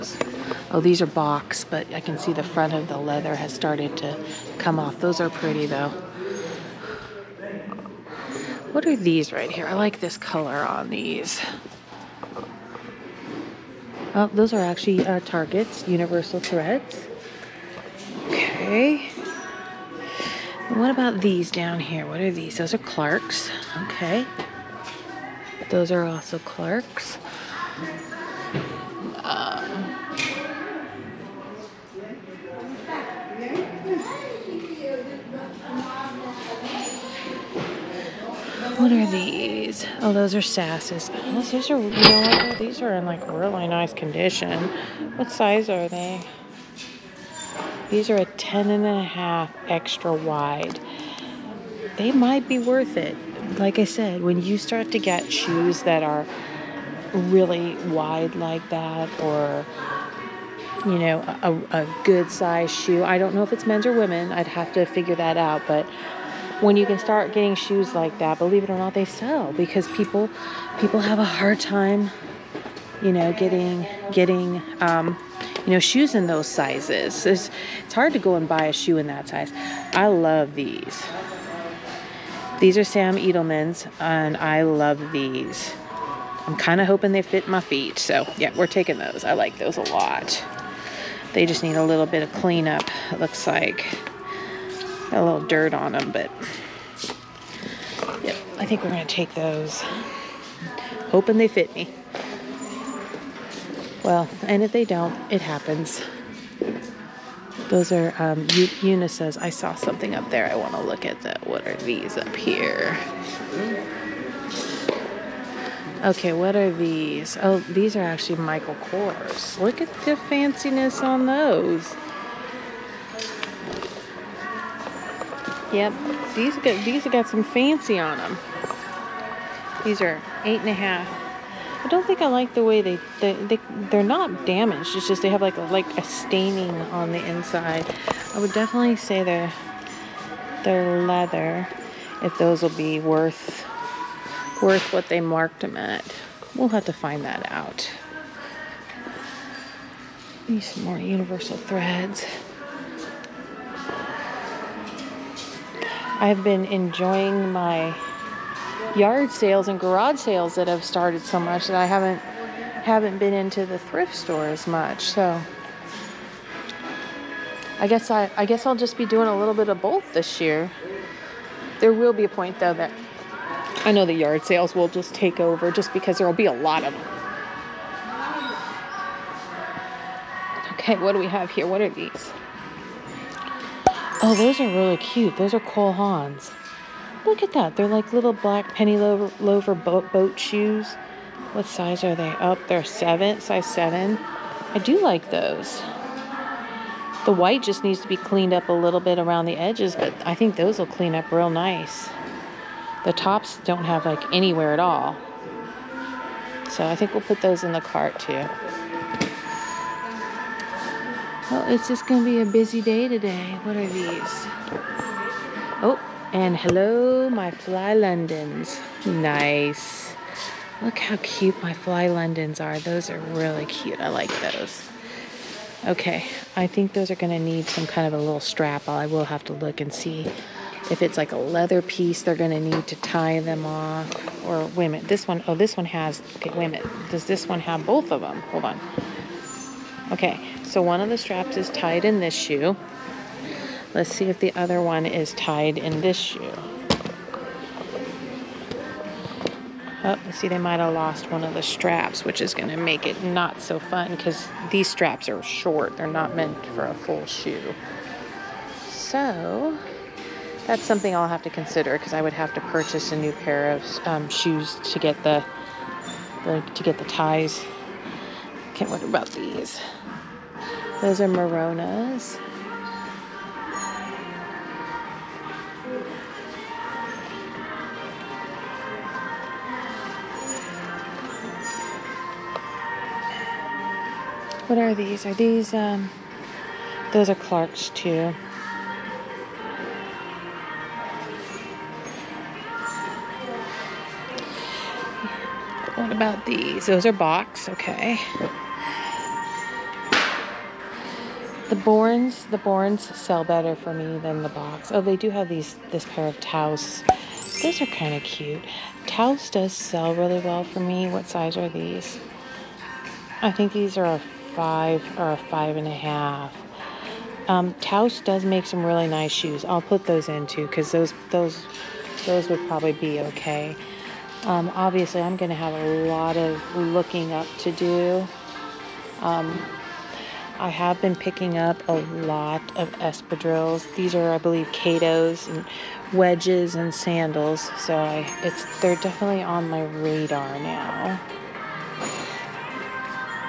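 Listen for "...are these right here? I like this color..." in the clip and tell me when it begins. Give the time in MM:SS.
00:08.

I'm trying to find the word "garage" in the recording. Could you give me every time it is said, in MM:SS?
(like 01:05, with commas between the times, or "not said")
02:39.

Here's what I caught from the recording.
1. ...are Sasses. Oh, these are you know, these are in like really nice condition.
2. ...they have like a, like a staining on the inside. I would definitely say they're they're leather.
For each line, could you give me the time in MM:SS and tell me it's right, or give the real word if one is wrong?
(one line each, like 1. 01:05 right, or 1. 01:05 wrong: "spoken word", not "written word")
1. 00:40 right
2. 02:15 right.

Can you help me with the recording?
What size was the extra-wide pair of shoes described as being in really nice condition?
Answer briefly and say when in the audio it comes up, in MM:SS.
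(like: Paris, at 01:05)
10.5 extra wide, at 00:48.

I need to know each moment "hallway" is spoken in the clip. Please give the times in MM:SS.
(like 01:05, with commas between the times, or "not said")
not said.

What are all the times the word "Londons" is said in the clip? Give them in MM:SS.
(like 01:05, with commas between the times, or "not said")
03:37, 03:42.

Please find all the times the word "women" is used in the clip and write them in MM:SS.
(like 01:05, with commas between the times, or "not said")
01:03.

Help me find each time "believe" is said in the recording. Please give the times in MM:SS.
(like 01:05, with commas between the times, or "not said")
01:08, 05:34.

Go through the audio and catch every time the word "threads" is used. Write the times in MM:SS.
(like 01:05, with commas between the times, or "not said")
00:16, 02:31.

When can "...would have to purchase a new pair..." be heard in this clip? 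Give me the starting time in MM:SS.
04:22.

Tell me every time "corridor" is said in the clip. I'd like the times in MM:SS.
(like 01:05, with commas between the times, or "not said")
not said.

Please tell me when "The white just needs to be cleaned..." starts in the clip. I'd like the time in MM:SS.
03:17.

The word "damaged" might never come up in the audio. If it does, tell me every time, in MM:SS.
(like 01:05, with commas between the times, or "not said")
02:14.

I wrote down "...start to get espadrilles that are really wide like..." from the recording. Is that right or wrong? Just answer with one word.
wrong.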